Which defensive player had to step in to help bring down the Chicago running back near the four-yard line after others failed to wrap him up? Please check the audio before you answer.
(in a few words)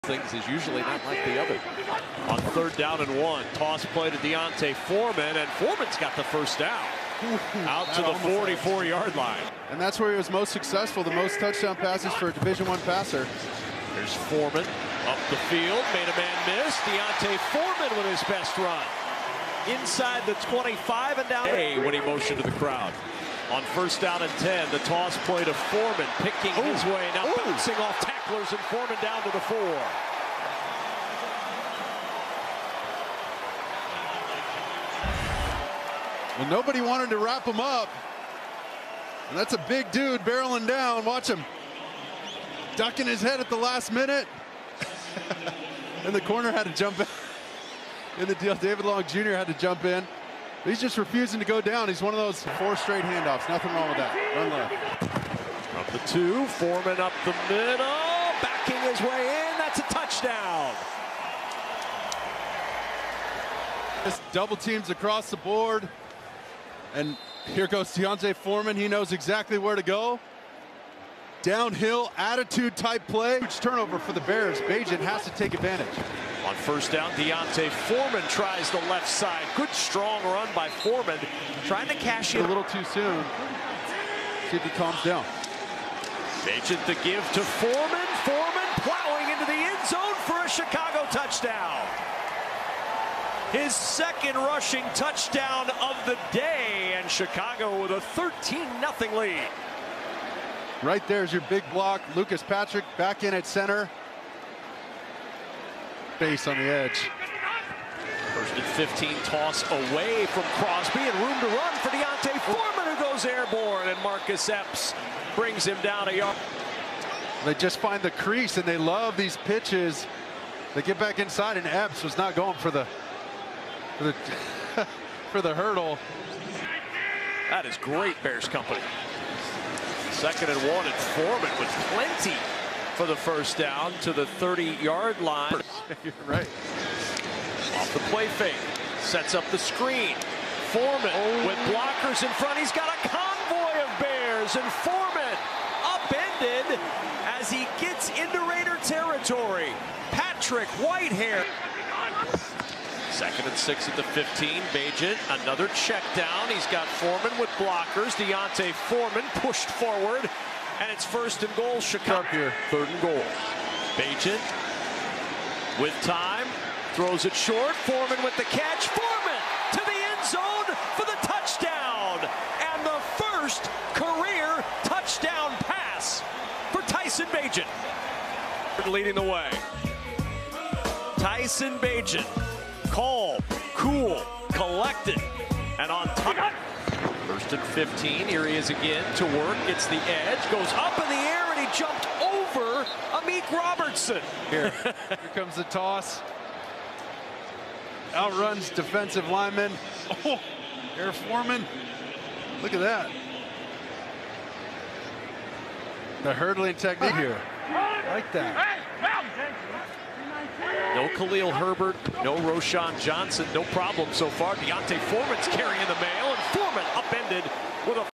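David Long Jr.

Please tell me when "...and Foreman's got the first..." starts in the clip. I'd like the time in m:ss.
0:05.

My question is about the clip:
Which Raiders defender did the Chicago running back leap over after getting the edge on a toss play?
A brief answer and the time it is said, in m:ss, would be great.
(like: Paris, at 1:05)
Amik Robertson, at 3:13.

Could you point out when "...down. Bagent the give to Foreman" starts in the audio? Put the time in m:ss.
1:25.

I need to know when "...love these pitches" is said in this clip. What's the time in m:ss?
1:58.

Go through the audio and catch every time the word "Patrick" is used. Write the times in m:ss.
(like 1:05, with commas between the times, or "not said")
1:42, 2:30.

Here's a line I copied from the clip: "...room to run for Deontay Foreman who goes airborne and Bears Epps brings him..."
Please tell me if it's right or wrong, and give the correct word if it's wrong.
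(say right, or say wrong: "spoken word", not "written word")
wrong: "Marcus", not "Bears".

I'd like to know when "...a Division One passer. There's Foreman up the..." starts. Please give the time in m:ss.
0:12.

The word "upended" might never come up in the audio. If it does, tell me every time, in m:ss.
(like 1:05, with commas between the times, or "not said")
2:25, 3:36.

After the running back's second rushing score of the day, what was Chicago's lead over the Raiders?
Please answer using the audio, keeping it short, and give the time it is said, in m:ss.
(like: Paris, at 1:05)
13-0, at 1:38.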